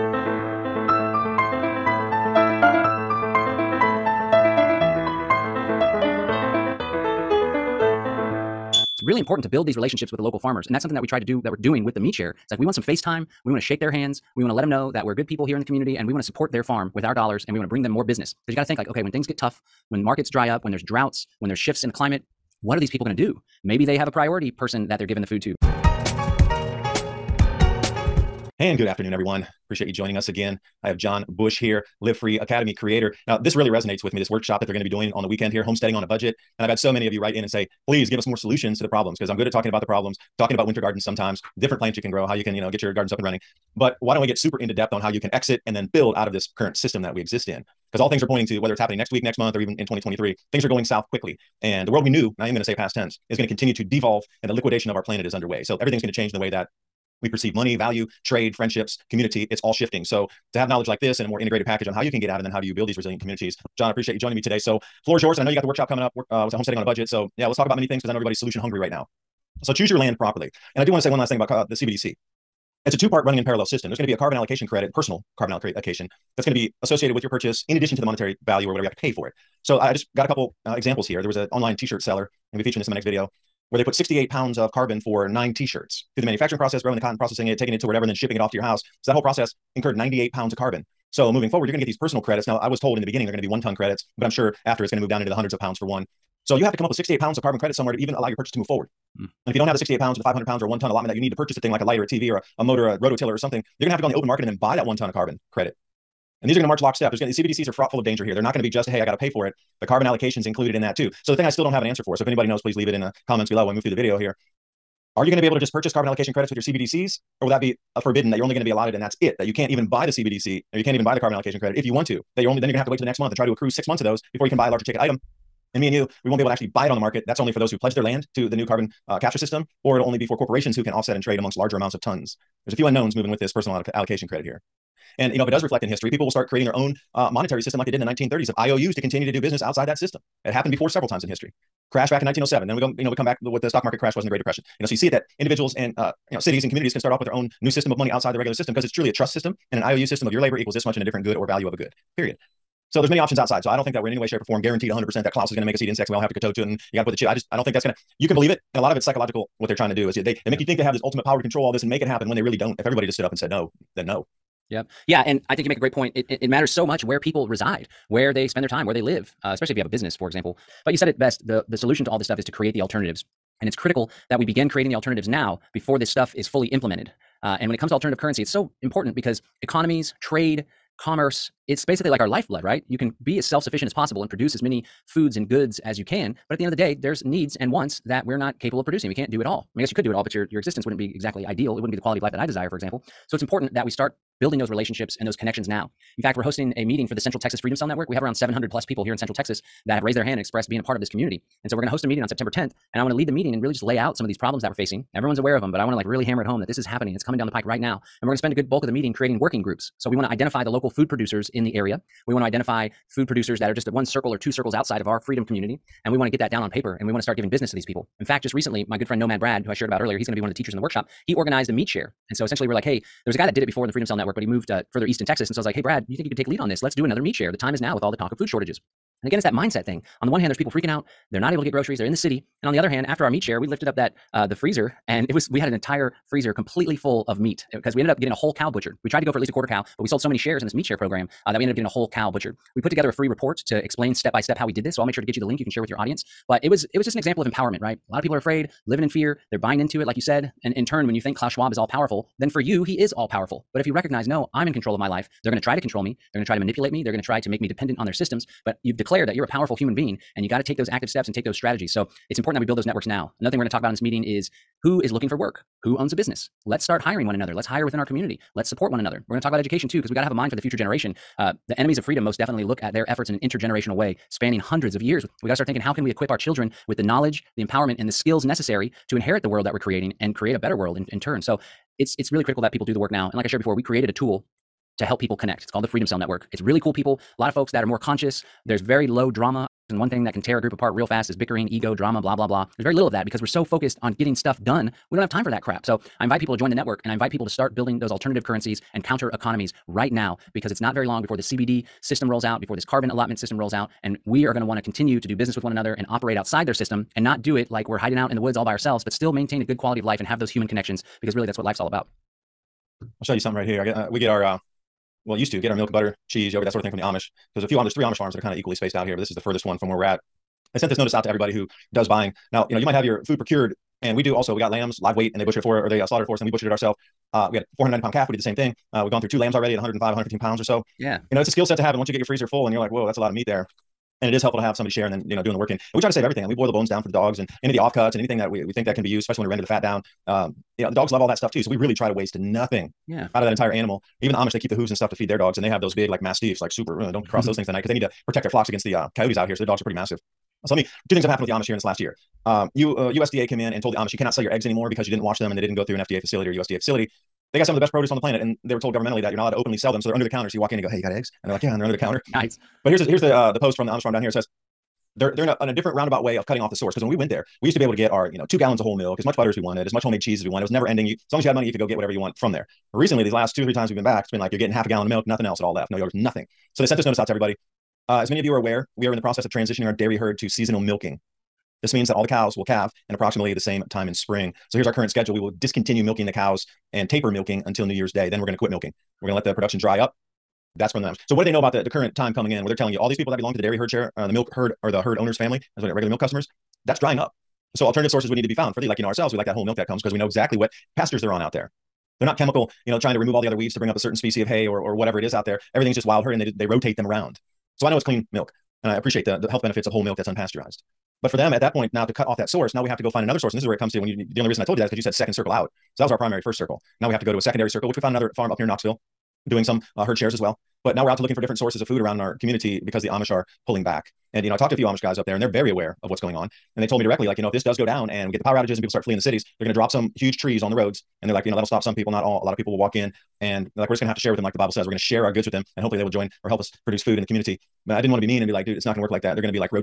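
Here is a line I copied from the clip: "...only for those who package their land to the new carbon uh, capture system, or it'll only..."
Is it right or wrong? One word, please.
wrong.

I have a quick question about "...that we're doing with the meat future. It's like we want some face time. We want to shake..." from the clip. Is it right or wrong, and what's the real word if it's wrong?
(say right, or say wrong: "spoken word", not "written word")
wrong: "share", not "future".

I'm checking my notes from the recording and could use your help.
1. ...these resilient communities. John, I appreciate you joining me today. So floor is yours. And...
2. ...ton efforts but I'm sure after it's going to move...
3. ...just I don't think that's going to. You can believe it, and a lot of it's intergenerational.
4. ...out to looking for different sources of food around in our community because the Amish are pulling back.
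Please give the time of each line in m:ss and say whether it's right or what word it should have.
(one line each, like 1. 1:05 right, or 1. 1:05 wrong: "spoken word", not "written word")
1. 1:02 right
2. 1:33 wrong: "credits", not "efforts"
3. 2:37 wrong: "psychological", not "intergenerational"
4. 7:01 right.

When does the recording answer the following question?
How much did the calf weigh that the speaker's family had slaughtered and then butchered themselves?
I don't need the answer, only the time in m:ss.
5:27.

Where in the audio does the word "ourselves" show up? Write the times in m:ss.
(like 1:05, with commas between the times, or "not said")
5:08, 5:26, 6:39.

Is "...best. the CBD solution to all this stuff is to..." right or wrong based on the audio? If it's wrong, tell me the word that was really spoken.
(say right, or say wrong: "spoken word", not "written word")
wrong: "The", not "CBD".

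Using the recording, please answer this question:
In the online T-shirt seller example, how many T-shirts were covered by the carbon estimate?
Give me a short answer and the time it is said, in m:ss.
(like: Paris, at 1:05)
9, at 1:25.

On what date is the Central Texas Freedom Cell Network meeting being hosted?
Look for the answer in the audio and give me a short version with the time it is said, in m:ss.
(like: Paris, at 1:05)
September 10th, at 3:22.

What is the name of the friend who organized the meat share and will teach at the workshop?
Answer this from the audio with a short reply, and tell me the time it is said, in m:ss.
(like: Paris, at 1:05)
Nomad Brad, at 3:39.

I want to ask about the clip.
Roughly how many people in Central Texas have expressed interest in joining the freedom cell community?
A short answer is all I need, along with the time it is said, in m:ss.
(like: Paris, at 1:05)
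700, at 3:18.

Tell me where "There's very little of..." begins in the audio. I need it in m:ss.
4:52.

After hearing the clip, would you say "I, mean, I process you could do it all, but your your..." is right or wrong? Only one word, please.
wrong.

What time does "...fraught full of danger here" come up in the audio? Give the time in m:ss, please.
1:47.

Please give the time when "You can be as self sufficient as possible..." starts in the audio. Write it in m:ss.
3:02.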